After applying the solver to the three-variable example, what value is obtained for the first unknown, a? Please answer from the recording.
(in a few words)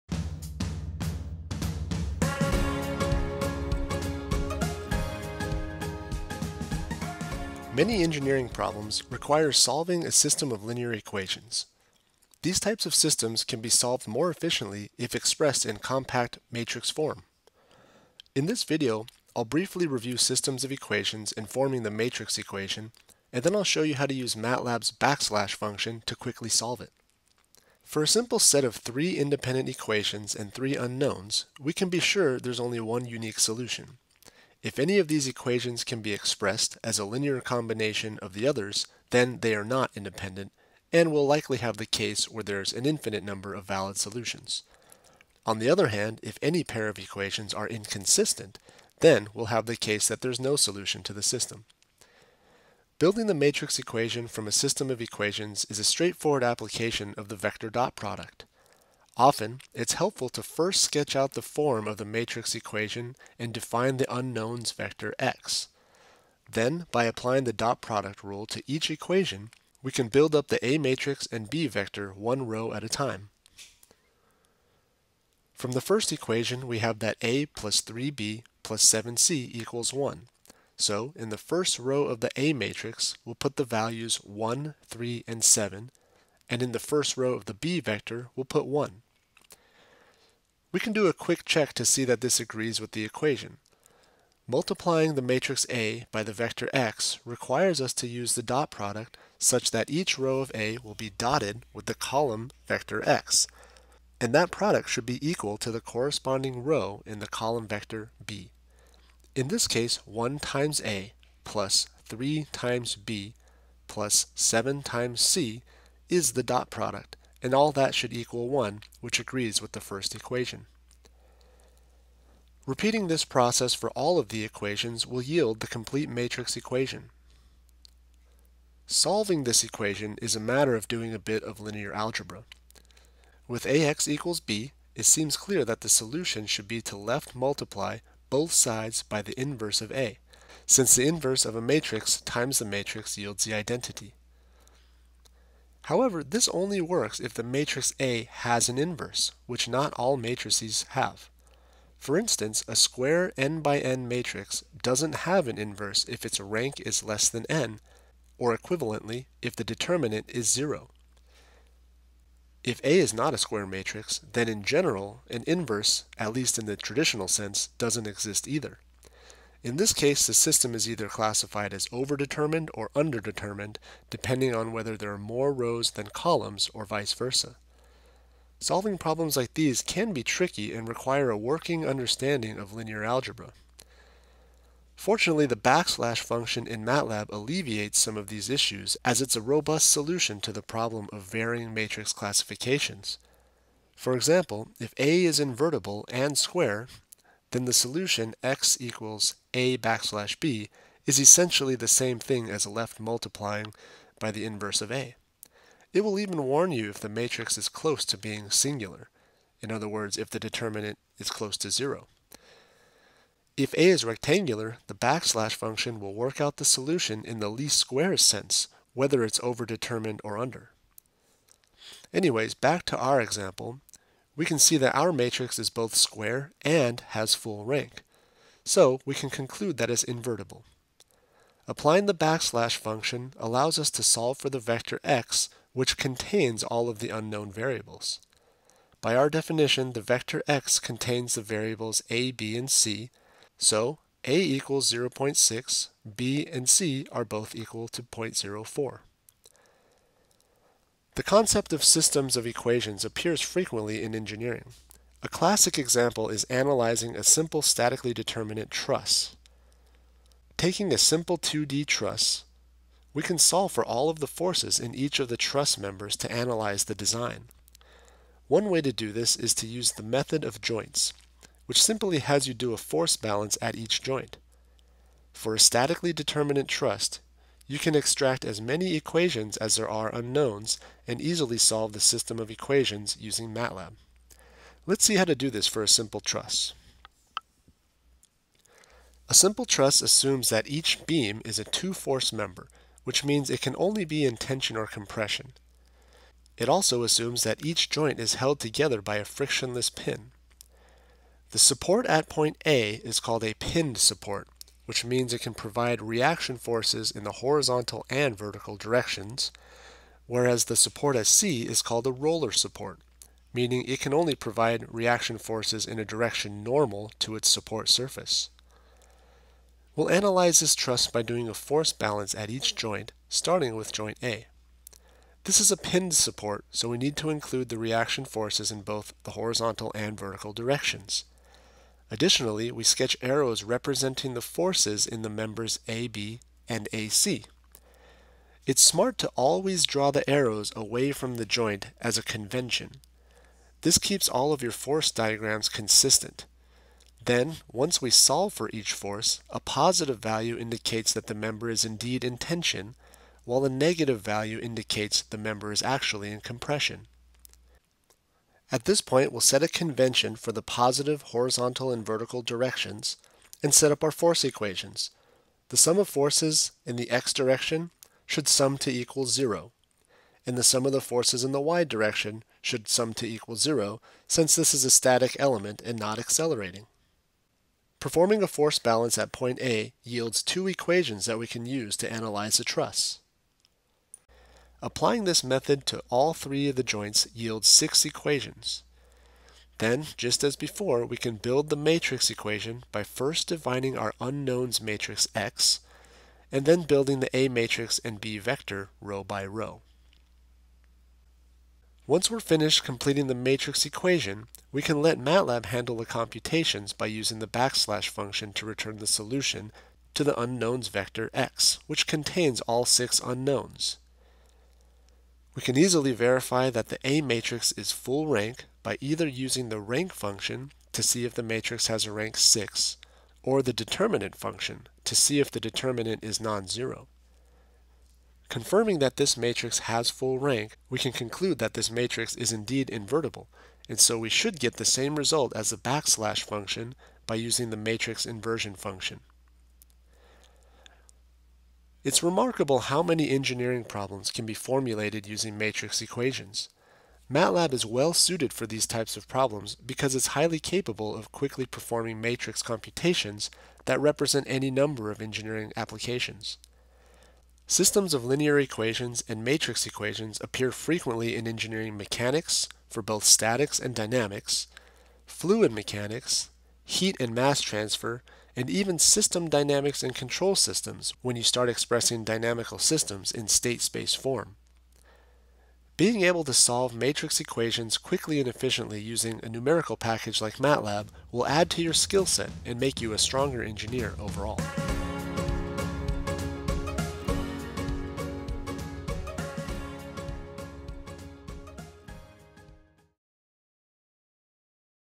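0.6.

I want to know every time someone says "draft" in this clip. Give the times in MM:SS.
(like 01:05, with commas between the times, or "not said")
not said.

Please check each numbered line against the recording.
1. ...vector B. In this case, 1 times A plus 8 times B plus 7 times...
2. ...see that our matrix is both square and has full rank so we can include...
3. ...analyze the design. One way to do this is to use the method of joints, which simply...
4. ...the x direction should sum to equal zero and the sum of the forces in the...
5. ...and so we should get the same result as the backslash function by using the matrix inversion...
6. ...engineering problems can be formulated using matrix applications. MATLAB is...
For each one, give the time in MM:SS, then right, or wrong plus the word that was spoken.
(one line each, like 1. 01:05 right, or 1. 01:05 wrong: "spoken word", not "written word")
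1. 01:47 wrong: "3", not "8"
2. 03:44 wrong: "conclude", not "include"
3. 04:26 right
4. 06:06 right
5. 07:13 right
6. 07:23 wrong: "equations", not "applications".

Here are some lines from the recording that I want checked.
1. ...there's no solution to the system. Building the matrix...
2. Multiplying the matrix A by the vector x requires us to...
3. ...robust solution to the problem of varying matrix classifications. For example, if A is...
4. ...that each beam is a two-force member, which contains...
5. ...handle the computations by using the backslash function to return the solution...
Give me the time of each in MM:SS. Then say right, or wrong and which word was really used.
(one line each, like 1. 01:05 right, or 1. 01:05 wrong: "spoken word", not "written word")
1. 00:50 right
2. 01:34 right
3. 03:09 right
4. 04:50 wrong: "means", not "contains"
5. 06:45 right.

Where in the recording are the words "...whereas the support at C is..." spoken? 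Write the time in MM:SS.
05:10.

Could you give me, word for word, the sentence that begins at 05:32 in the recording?
Additionally, we sketch arrows representing the forces in the members AB and AC.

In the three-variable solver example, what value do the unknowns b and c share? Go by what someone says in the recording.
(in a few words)
0.04.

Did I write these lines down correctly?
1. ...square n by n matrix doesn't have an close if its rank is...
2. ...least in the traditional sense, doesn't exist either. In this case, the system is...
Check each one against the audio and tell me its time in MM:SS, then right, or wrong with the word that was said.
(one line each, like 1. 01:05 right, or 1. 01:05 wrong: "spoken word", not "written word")
1. 02:32 wrong: "inverse", not "close"
2. 02:46 right.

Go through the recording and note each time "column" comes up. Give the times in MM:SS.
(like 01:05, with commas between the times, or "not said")
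01:41, 01:47, 02:56.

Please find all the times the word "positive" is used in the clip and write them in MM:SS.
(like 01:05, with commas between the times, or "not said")
05:49, 06:00.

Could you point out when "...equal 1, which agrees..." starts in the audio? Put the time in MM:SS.
01:58.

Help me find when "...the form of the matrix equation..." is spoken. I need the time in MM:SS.
01:01.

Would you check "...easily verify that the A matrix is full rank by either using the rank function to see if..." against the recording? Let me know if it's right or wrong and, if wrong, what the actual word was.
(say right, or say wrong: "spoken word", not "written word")
right.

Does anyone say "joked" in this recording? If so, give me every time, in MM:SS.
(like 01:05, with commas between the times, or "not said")
not said.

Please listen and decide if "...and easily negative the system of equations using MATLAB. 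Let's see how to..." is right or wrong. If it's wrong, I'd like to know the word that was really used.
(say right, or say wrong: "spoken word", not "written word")
wrong: "solve", not "negative".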